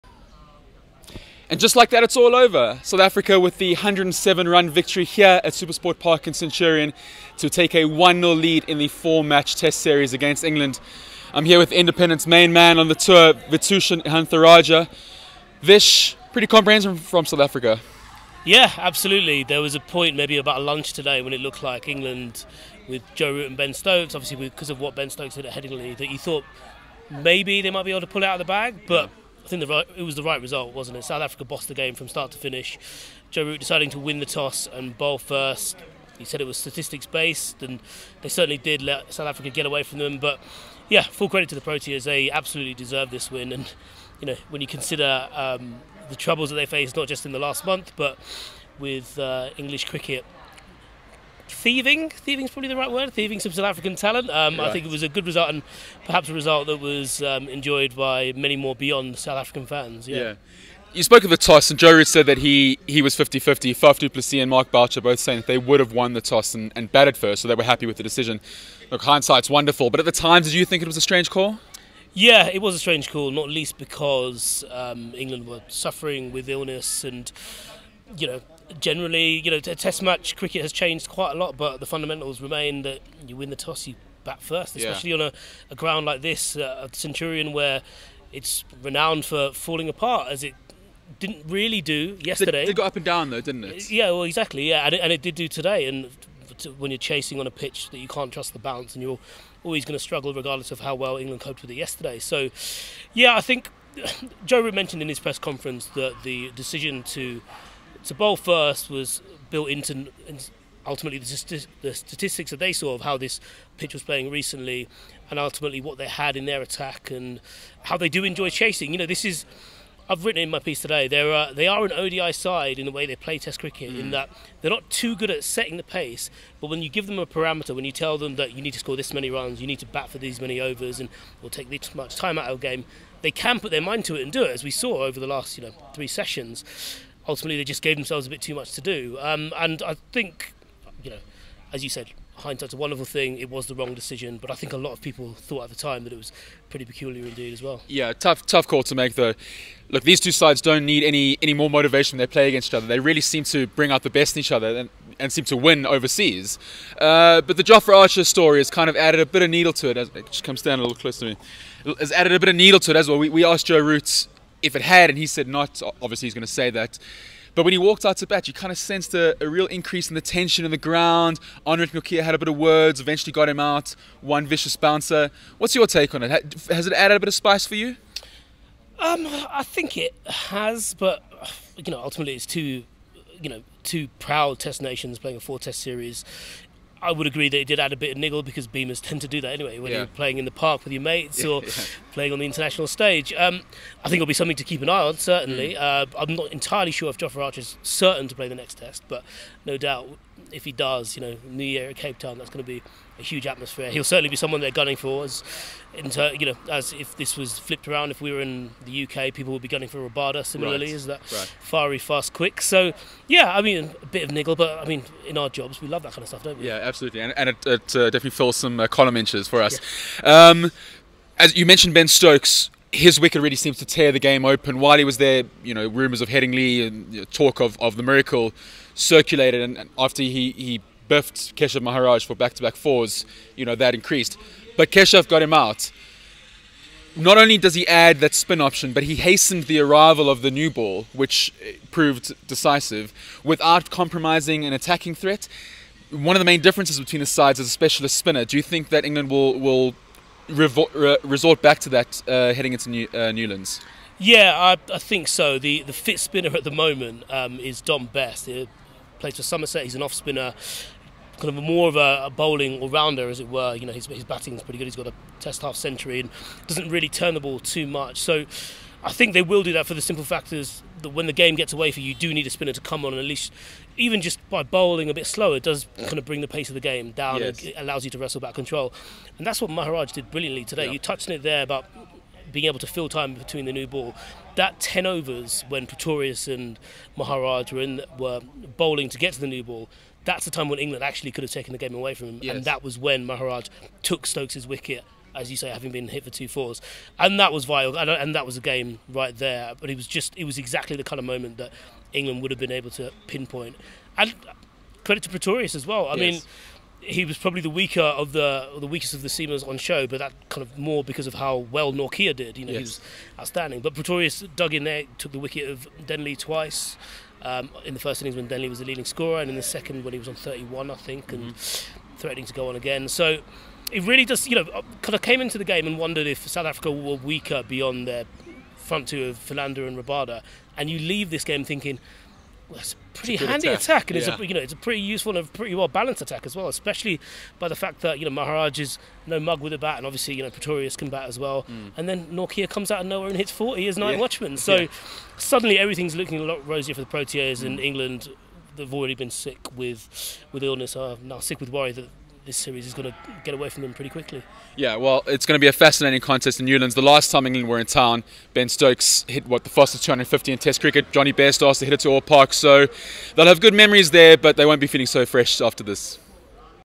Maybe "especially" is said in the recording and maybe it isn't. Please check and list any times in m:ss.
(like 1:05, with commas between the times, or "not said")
1:24, 5:36.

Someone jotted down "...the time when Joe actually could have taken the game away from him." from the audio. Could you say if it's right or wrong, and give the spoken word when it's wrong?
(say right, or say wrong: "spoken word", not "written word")
wrong: "England", not "Joe".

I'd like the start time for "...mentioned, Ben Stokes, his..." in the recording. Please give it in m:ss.
3:41.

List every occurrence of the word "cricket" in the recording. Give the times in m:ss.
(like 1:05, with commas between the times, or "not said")
0:49, 1:20, 2:03, 6:00.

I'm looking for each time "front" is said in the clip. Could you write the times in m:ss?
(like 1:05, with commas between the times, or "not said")
5:28.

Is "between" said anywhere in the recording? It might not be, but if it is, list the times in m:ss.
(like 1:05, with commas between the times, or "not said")
4:06, 4:43.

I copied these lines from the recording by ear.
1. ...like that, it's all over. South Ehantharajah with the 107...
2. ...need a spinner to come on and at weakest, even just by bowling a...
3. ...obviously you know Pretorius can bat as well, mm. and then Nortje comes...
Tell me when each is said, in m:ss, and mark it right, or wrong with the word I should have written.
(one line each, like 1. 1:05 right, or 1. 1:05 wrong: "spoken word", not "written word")
1. 0:01 wrong: "Africa", not "Ehantharajah"
2. 4:32 wrong: "least", not "weakest"
3. 5:40 right.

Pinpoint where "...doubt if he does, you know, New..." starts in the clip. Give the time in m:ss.
3:19.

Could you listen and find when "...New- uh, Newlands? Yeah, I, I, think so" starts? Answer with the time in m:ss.
4:12.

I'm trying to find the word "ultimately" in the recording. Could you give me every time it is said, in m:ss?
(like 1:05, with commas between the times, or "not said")
1:50, 1:55, 2:17, 3:02.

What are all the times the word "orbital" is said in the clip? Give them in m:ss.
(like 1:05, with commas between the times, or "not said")
not said.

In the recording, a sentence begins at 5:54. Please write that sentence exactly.
Yeah, well, it's going to be a fascinating contest in Newlands.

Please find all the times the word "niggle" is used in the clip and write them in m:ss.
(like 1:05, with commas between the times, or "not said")
3:08, 3:34.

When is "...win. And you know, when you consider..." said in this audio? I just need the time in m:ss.
0:43.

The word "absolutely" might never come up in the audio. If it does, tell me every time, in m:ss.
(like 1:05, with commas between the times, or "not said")
0:18, 0:42, 3:36.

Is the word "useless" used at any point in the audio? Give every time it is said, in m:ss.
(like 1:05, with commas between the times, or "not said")
not said.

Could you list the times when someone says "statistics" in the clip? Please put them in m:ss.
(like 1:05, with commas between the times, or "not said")
0:36, 1:51.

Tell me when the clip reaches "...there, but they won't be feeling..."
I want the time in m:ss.
6:04.